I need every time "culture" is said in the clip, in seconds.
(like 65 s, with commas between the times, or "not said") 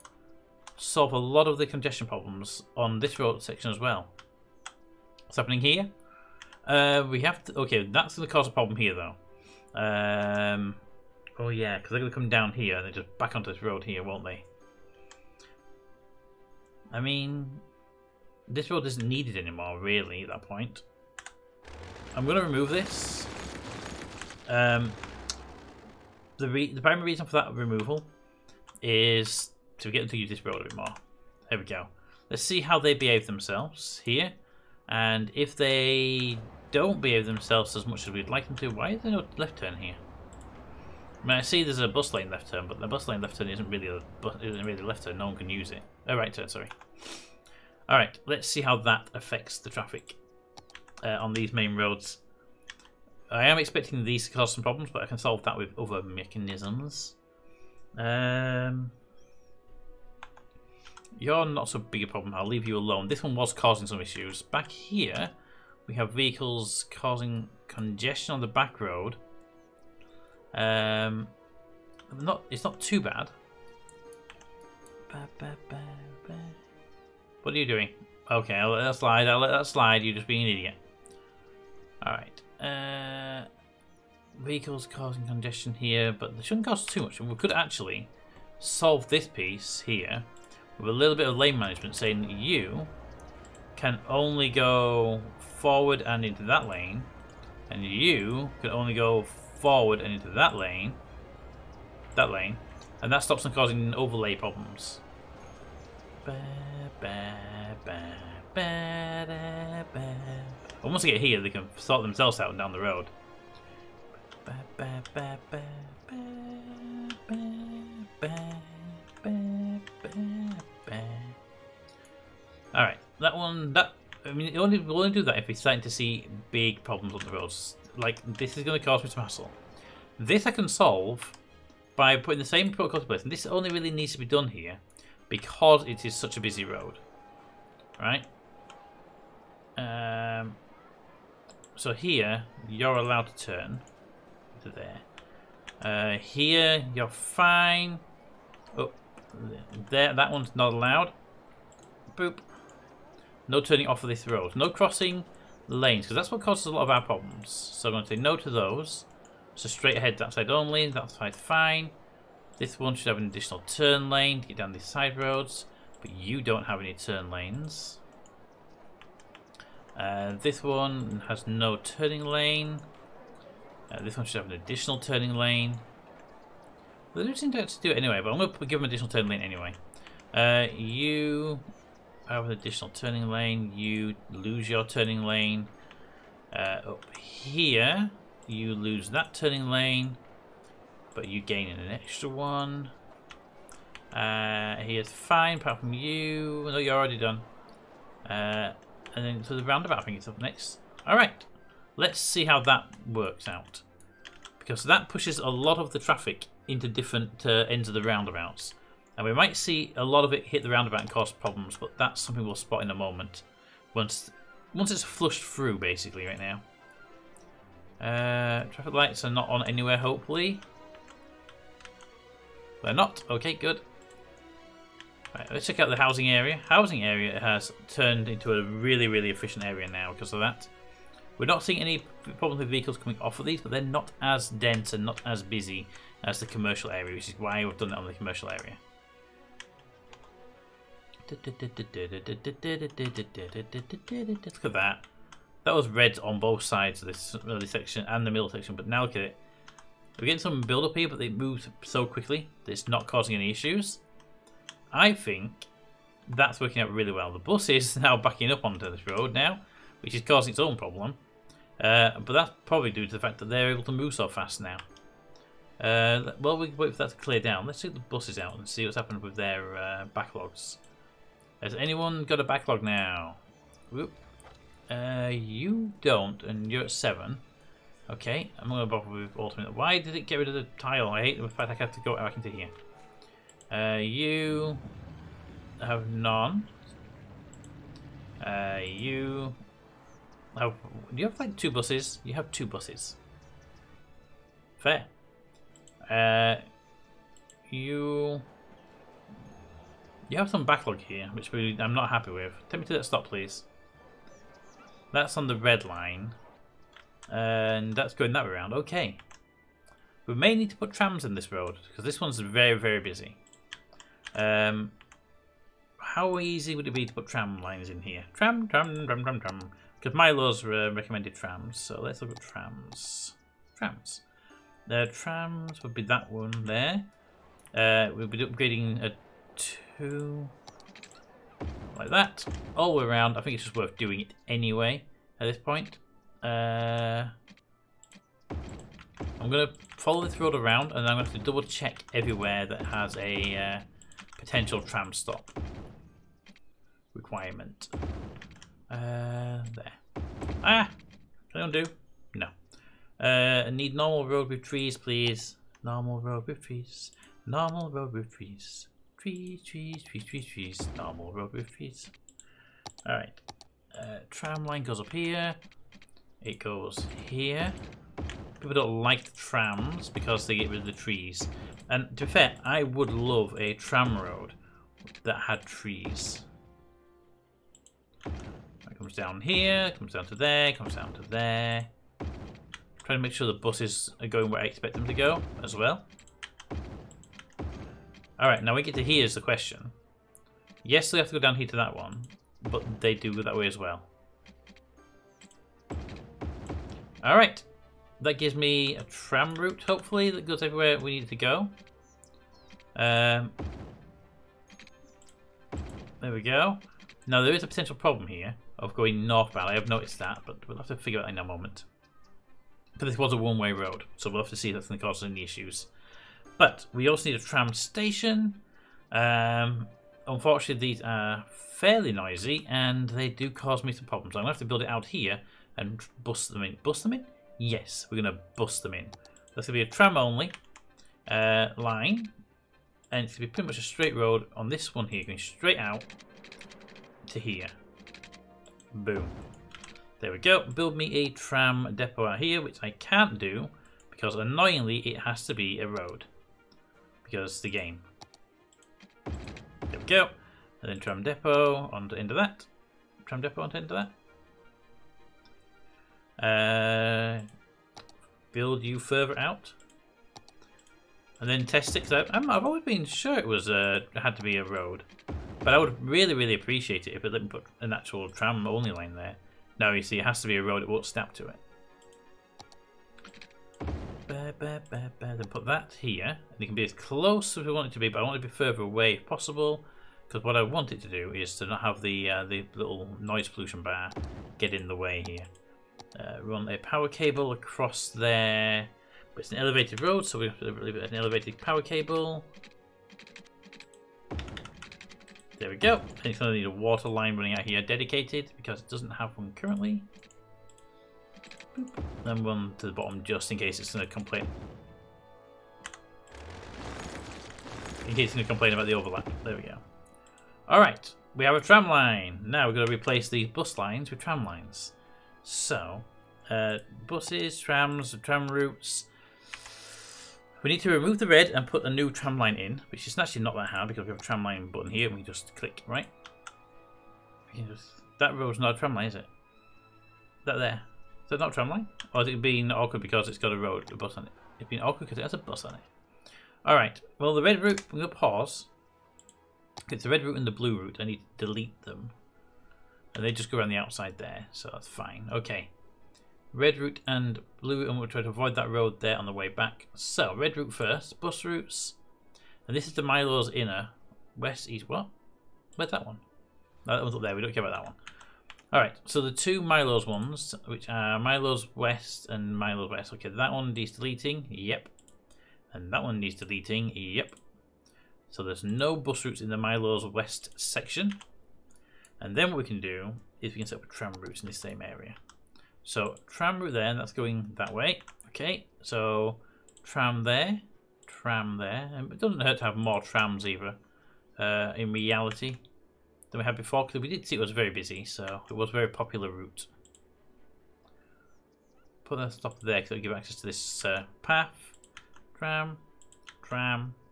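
not said.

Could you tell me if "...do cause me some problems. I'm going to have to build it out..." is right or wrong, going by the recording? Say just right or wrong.
right.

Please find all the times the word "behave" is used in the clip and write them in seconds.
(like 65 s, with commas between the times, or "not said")
32 s, 36 s.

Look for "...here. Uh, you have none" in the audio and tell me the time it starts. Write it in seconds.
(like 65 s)
282 s.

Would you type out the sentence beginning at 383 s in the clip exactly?
Trying to make sure the buses are going where I expect them to go as well.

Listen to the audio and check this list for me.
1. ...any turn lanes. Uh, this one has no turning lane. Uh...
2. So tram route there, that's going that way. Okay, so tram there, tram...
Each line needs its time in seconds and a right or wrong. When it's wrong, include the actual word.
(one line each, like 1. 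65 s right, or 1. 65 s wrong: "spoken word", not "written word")
1. 166 s right
2. 575 s right.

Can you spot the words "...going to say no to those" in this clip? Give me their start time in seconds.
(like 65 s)
157 s.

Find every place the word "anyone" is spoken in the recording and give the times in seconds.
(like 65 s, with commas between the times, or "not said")
271 s.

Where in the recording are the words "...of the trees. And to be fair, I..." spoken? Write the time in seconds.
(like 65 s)
370 s.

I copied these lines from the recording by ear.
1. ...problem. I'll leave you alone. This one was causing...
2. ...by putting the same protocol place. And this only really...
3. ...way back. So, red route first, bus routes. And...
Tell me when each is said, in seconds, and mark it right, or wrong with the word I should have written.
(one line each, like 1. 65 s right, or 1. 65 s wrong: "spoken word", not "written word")
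1. 62 s right
2. 131 s right
3. 549 s right.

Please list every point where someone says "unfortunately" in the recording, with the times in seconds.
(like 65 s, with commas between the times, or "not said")
420 s.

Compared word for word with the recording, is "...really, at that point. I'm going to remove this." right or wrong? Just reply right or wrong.
right.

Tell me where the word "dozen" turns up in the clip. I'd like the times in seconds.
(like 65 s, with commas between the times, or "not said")
not said.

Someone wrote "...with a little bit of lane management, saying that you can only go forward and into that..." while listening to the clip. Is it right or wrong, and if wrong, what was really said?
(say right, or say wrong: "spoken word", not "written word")
right.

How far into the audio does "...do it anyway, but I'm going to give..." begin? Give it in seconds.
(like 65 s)
177 s.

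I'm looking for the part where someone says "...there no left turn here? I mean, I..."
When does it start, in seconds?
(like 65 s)
39 s.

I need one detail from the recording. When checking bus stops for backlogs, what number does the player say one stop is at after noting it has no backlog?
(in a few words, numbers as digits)
7.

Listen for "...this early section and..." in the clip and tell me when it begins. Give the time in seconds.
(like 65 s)
247 s.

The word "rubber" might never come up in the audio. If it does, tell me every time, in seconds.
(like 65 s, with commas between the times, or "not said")
361 s.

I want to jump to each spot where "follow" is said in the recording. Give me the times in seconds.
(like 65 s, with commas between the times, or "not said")
339 s.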